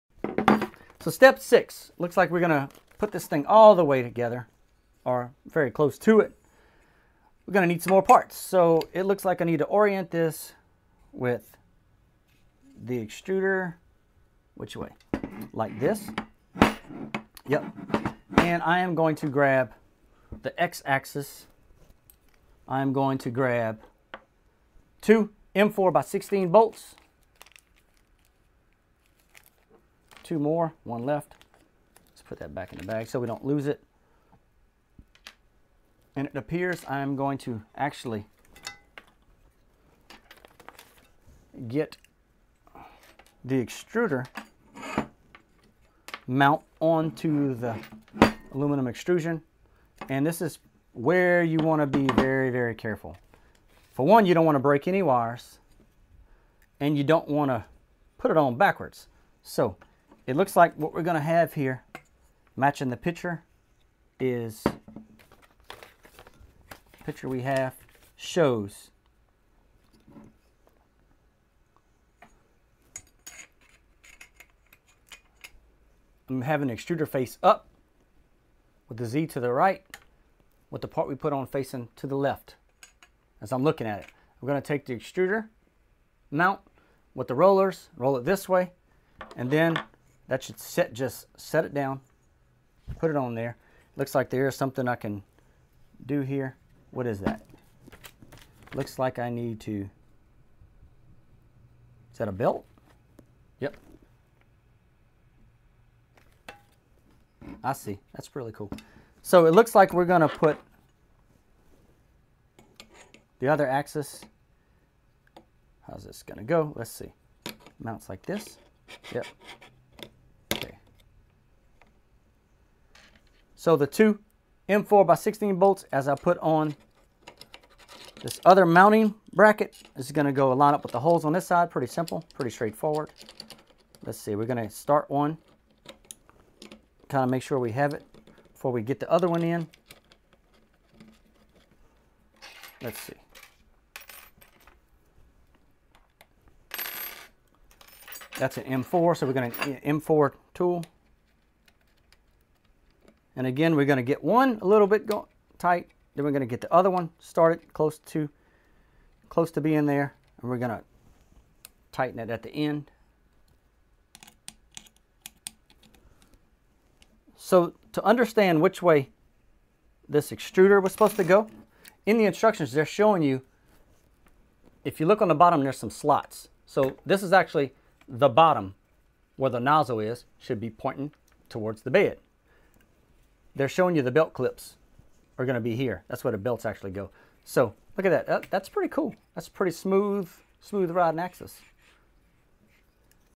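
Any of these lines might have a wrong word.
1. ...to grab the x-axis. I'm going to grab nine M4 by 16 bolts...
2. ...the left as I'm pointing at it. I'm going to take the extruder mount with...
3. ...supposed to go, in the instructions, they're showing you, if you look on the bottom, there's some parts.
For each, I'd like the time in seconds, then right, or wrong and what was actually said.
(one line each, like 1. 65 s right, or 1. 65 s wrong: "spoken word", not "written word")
1. 19 s wrong: "two", not "nine"
2. 82 s wrong: "looking", not "pointing"
3. 170 s wrong: "slots", not "parts".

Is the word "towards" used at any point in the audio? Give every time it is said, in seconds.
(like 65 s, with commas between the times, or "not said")
181 s.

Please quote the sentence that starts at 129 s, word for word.
This is gonna go line up with the holes on this side.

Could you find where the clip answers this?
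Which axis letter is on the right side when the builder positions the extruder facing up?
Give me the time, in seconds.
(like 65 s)
79 s.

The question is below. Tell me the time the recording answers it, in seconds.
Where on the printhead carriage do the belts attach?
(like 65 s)
184 s.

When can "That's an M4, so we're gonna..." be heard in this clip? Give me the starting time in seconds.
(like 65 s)
148 s.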